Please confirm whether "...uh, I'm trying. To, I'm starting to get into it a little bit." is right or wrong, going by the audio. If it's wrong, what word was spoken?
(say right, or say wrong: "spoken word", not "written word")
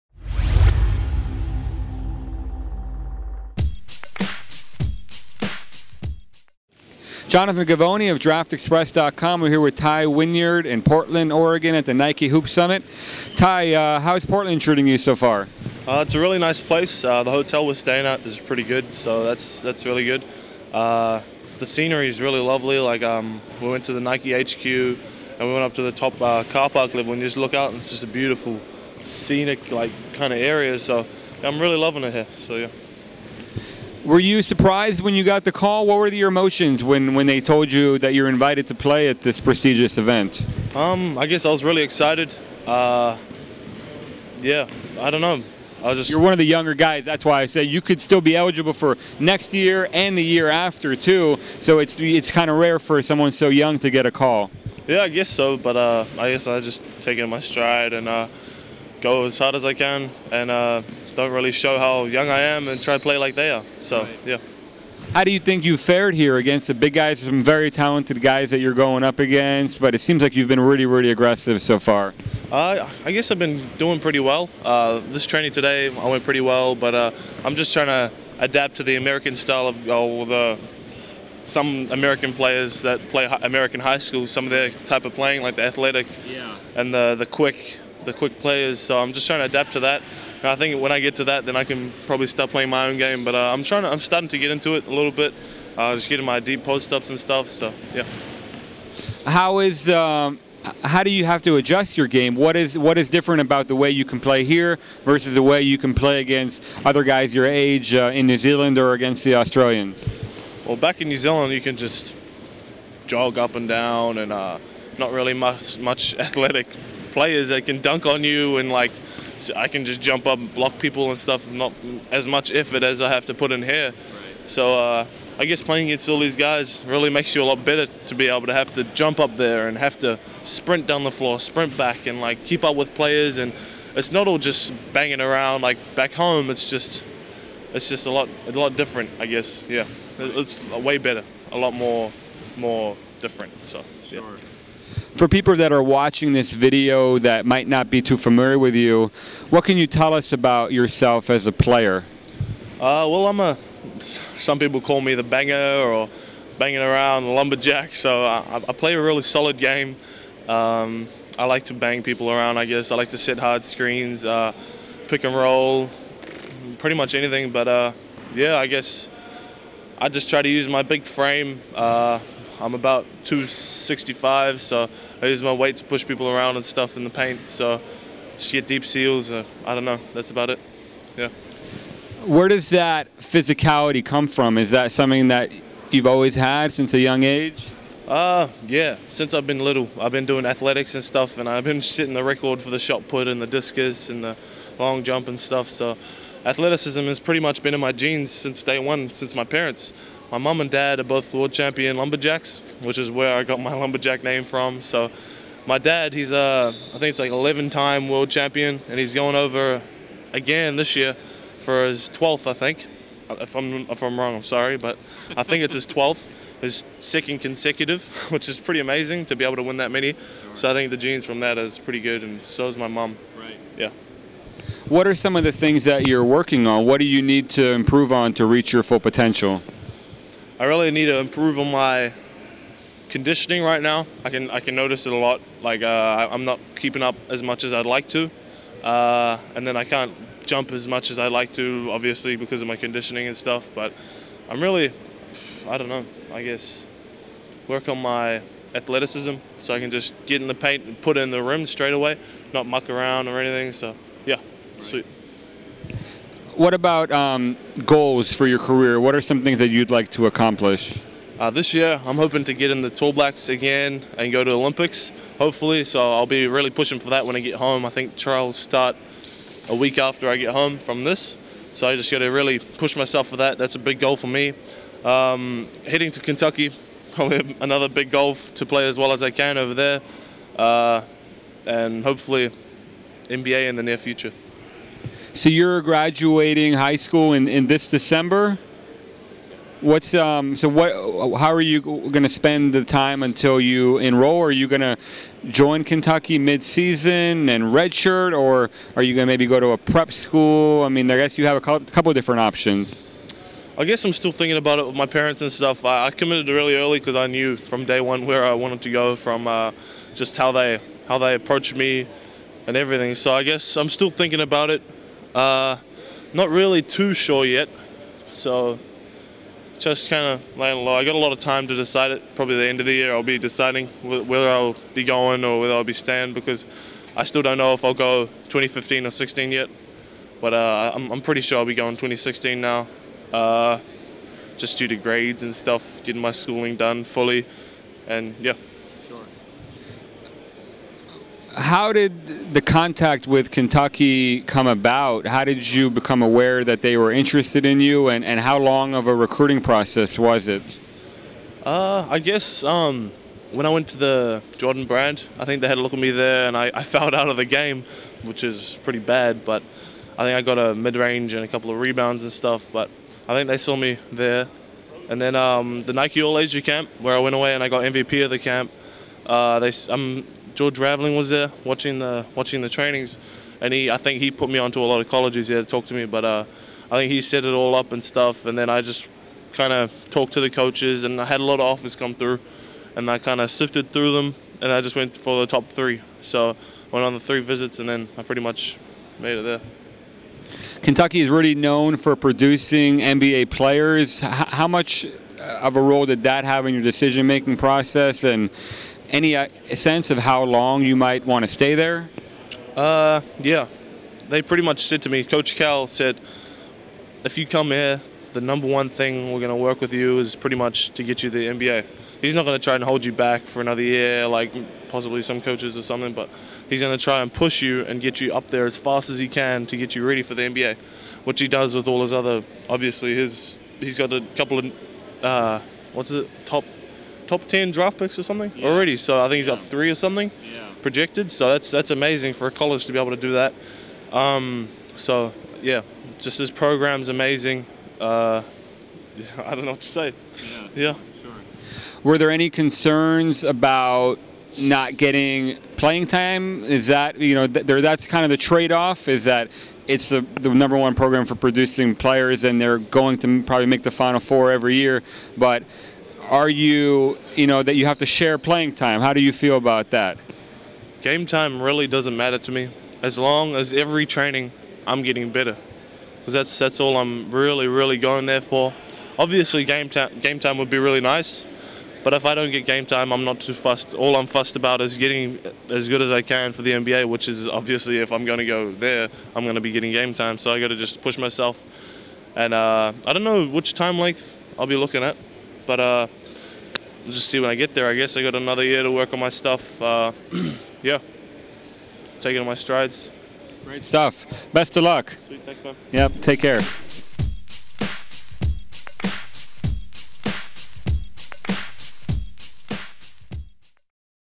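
right.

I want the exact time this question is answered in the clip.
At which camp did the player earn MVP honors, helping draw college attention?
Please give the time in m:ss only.
6:05.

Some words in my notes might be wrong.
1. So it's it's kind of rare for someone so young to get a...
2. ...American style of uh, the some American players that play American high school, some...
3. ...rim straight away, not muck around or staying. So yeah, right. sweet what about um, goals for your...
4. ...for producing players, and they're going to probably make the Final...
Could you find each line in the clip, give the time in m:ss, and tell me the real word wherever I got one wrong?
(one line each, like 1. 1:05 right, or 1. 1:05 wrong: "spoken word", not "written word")
1. 0:51 right
2. 1:18 right
3. 4:11 wrong: "anything", not "staying"
4. 7:31 right.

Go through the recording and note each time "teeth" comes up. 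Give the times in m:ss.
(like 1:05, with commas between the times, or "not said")
not said.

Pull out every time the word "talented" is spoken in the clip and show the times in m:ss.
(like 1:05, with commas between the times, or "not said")
1:07.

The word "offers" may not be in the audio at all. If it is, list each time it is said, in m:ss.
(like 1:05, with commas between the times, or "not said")
6:21.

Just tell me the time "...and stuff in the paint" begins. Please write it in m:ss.
2:56.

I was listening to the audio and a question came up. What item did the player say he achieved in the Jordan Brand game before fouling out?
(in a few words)
A mid range.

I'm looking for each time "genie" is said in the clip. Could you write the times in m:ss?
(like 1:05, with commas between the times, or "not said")
not said.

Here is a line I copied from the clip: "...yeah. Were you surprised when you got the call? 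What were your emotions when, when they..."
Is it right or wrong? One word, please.
right.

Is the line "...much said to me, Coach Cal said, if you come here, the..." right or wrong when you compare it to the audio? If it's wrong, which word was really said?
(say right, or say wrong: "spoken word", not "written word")
right.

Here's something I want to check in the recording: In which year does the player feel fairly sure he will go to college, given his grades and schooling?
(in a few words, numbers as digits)
2016.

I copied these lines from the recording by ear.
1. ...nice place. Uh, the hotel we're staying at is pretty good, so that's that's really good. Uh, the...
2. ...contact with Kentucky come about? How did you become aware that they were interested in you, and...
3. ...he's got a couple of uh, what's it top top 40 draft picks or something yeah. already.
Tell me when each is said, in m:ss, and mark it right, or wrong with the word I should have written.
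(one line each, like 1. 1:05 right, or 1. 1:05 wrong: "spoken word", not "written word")
1. 0:16 right
2. 5:42 right
3. 7:03 wrong: "10", not "40".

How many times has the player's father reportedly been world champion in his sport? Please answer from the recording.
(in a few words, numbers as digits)
11.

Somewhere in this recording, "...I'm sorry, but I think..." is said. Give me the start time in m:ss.
3:34.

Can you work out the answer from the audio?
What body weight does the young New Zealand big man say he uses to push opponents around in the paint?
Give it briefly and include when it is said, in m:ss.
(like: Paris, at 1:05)
265, at 2:53.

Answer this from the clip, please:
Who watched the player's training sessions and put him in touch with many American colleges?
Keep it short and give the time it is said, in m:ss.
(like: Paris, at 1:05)
George Raveling, at 6:10.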